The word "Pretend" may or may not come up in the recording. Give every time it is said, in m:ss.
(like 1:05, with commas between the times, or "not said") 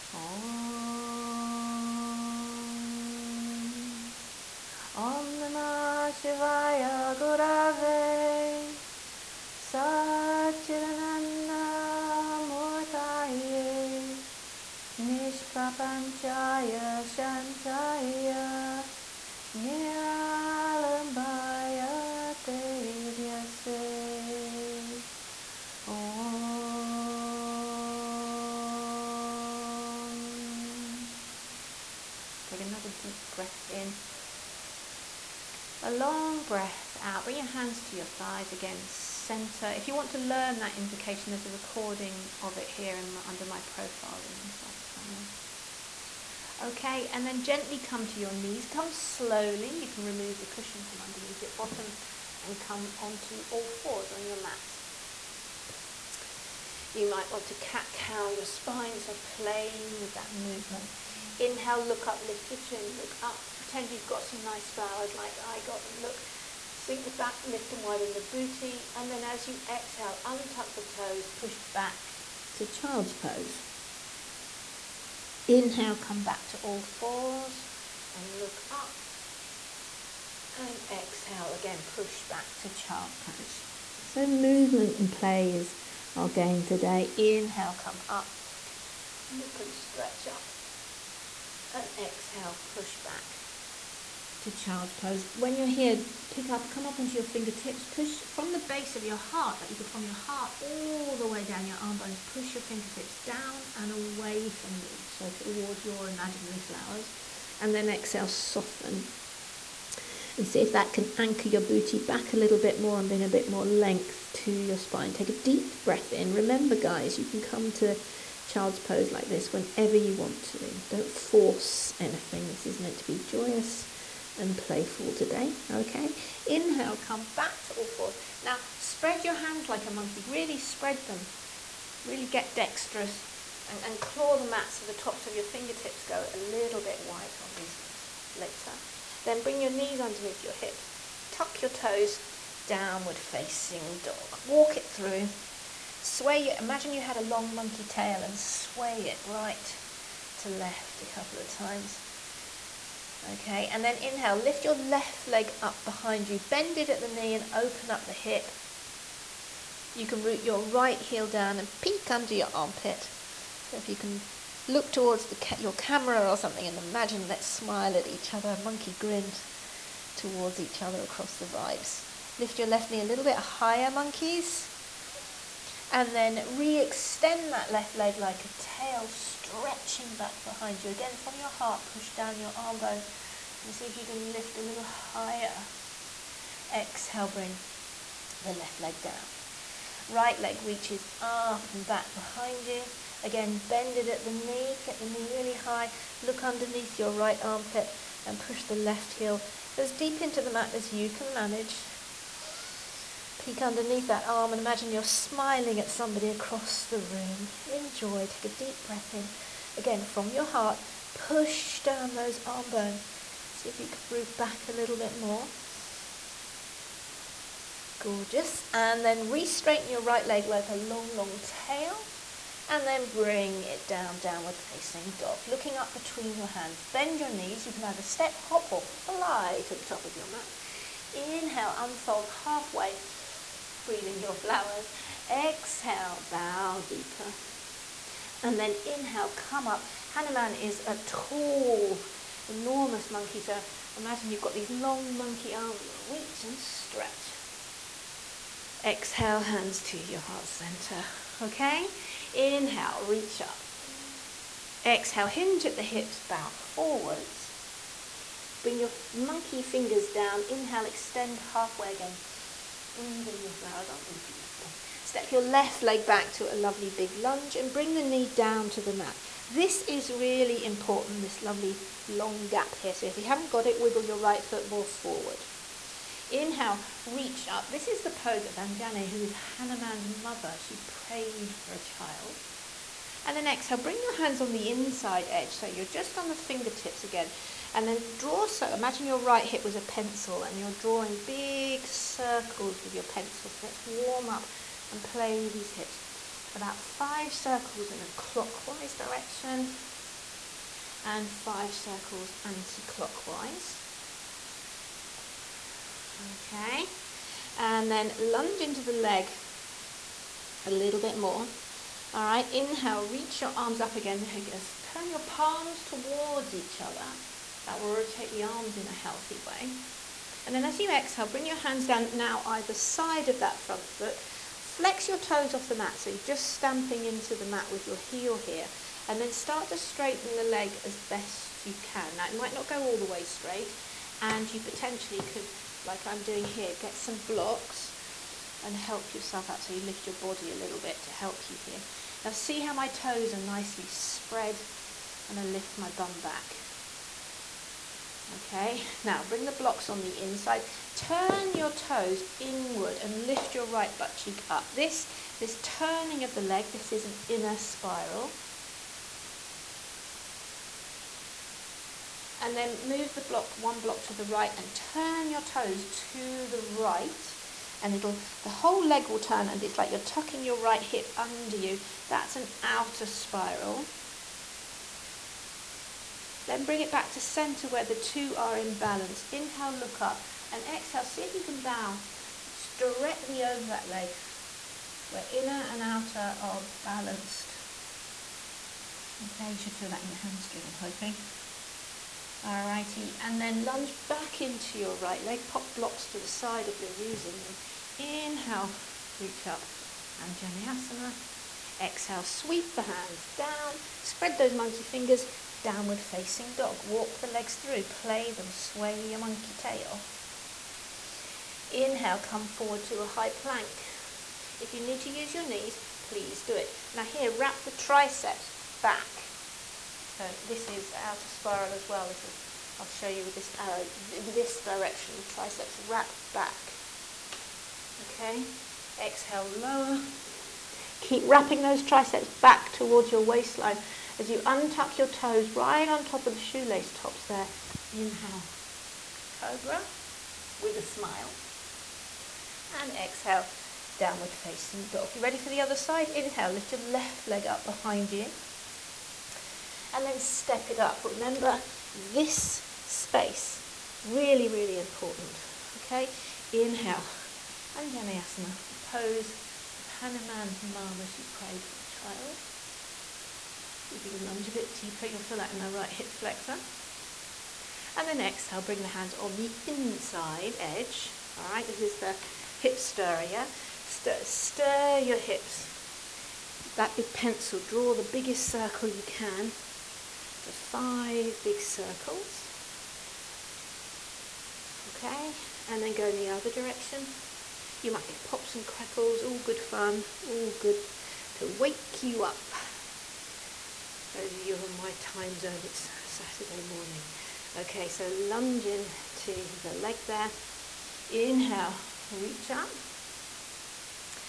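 1:03.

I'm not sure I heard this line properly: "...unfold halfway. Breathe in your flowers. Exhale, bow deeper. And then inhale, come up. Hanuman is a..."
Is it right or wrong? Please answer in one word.
right.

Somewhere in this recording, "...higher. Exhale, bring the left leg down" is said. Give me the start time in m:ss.
3:04.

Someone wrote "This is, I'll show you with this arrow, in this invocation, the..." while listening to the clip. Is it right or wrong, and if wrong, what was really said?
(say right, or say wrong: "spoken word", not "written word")
wrong: "direction", not "invocation".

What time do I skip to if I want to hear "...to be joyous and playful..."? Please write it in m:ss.
2:02.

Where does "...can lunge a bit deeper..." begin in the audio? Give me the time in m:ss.
7:44.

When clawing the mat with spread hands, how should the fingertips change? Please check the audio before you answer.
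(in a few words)
Go a little bit white.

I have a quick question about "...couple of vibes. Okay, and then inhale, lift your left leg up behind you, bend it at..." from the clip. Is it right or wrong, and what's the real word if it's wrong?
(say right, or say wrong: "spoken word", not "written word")
wrong: "times", not "vibes".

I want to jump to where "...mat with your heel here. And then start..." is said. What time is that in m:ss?
5:27.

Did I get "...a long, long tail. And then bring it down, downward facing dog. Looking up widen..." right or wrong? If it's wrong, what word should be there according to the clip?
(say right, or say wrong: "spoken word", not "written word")
wrong: "between", not "widen".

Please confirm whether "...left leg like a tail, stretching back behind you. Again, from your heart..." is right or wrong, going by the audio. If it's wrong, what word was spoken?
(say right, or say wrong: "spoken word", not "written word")
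right.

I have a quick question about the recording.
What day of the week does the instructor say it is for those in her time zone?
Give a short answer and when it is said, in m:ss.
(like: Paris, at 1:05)
Saturday, at 8:16.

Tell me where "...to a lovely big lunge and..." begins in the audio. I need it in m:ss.
4:26.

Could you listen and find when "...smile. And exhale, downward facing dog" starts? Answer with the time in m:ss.
7:20.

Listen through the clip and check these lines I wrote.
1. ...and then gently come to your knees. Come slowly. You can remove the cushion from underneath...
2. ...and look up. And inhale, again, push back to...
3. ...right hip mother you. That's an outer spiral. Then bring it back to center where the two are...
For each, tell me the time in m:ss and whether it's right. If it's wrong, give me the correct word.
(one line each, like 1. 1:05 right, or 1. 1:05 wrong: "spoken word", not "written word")
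1. 0:47 right
2. 1:18 wrong: "exhale", not "inhale"
3. 6:10 wrong: "under", not "mother".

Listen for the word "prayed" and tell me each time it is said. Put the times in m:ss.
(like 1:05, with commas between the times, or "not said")
4:40, 7:41.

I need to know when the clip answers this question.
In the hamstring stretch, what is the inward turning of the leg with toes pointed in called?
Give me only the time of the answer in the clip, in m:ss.
5:57.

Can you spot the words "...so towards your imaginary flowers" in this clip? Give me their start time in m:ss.
1:45.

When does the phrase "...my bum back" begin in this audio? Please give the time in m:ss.
5:45.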